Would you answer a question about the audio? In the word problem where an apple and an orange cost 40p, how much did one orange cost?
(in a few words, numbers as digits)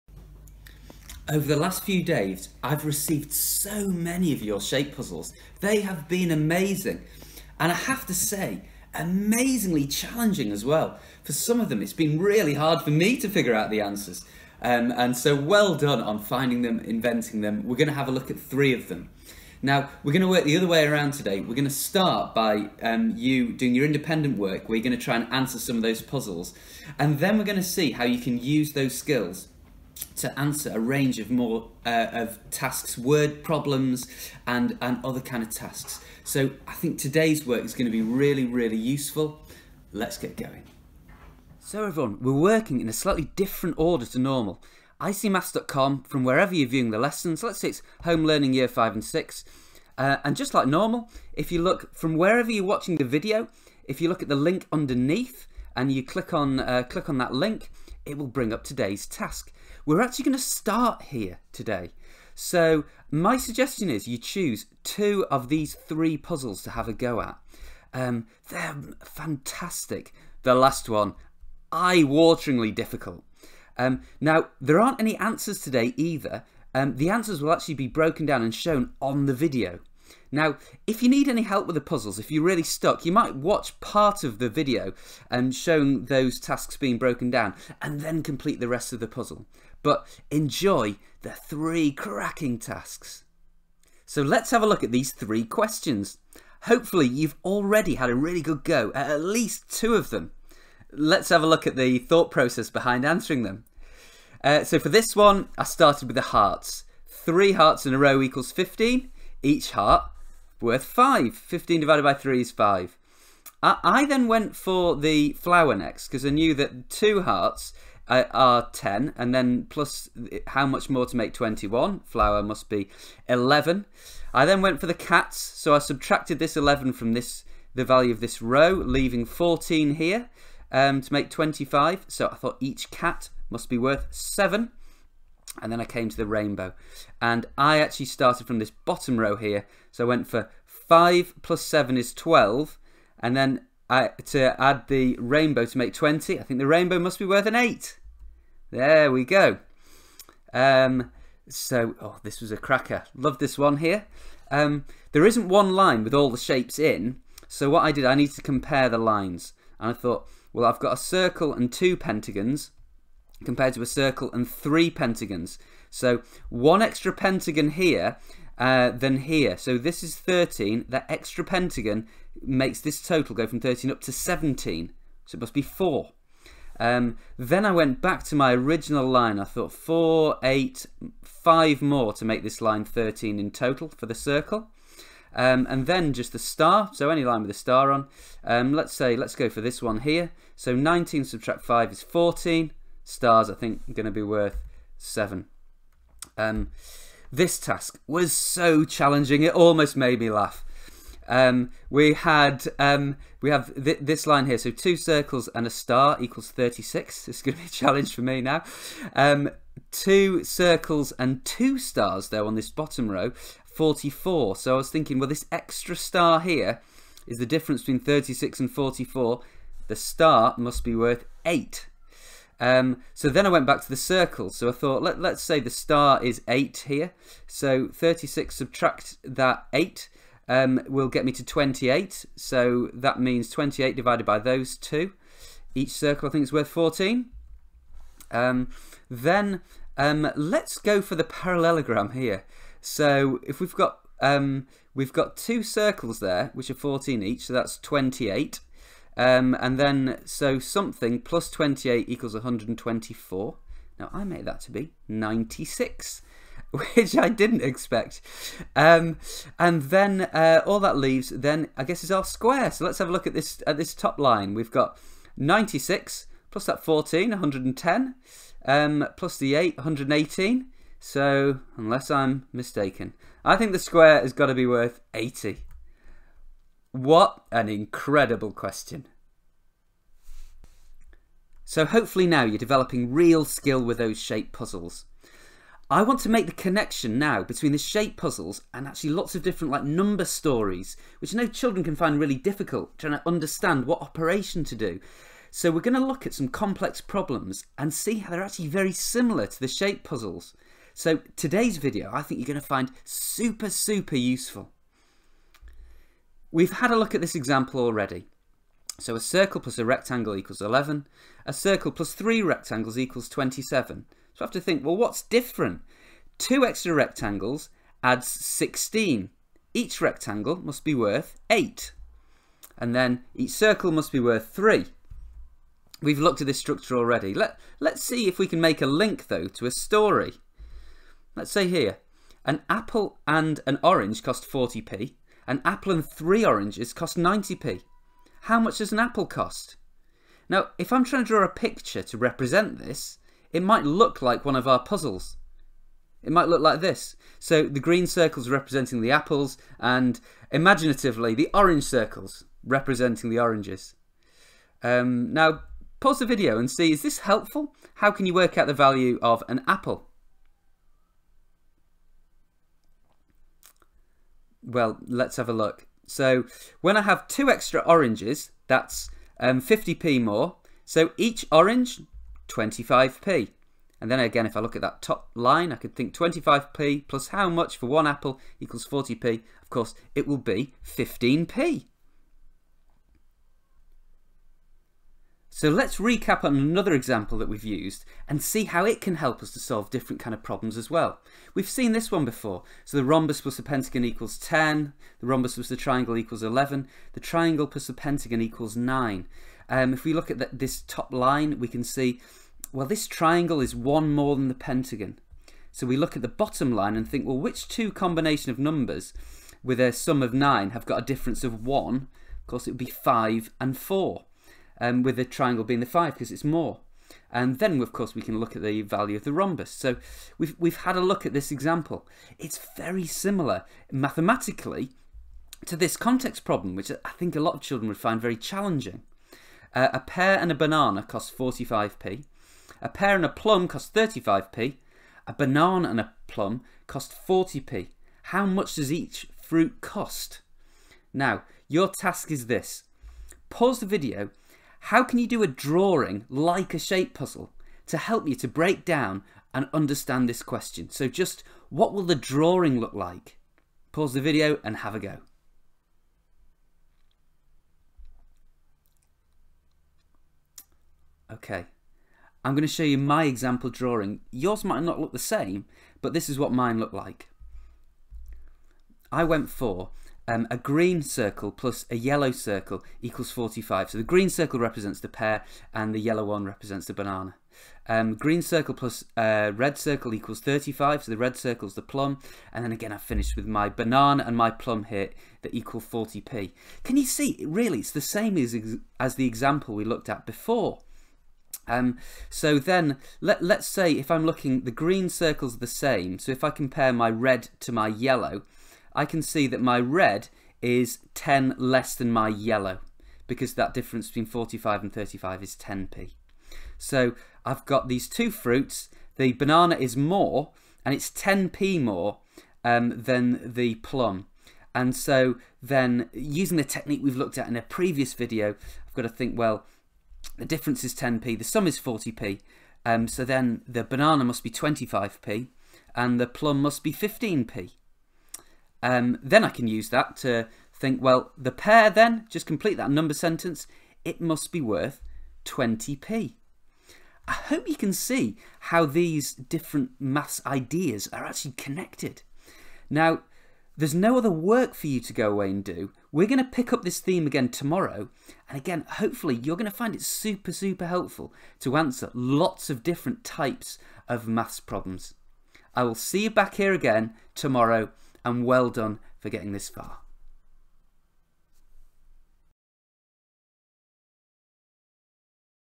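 25p.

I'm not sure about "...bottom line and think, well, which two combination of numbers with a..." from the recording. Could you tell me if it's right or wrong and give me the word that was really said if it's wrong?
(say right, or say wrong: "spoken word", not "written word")
right.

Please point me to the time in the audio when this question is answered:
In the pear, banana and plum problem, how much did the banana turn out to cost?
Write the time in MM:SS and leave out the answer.
08:43.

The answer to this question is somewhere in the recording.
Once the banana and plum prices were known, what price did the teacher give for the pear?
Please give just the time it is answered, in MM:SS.
08:54.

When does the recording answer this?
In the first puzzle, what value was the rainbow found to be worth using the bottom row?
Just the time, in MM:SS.
02:26.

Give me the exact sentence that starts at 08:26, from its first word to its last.
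So I've got these two fruits.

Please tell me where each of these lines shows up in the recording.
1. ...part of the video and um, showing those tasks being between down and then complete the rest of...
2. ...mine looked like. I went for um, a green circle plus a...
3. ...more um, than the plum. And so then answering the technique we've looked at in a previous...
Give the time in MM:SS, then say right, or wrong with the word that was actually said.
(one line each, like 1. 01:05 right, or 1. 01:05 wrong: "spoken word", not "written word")
1. 01:23 wrong: "broken", not "between"
2. 07:46 right
3. 08:31 wrong: "using", not "answering".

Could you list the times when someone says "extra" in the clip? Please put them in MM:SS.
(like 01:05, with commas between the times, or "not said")
02:46, 02:51, 03:35, 05:16, 06:07.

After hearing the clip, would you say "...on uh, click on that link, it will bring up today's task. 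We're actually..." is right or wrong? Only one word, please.
right.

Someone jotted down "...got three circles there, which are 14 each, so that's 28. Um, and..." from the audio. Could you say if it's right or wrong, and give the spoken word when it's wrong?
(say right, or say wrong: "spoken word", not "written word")
wrong: "two", not "three".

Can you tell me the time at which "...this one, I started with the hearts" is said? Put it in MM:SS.
01:44.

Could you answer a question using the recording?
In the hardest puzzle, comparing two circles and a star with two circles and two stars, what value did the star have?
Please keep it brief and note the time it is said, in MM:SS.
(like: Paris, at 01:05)
8, at 03:39.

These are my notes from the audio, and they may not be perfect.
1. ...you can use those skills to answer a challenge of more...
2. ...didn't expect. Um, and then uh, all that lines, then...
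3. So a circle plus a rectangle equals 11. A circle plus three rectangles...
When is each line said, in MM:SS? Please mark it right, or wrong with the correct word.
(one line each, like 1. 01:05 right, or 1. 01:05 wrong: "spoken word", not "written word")
1. 00:28 wrong: "range", not "challenge"
2. 04:17 wrong: "leaves", not "lines"
3. 05:09 right.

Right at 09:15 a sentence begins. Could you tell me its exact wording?
I will see you back here again tomorrow and well done for getting this far.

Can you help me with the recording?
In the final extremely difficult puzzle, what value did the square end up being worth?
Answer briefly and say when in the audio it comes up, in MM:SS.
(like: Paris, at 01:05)
80, at 04:33.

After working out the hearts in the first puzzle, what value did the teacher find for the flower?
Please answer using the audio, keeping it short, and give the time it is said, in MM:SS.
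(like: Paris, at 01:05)
11, at 02:02.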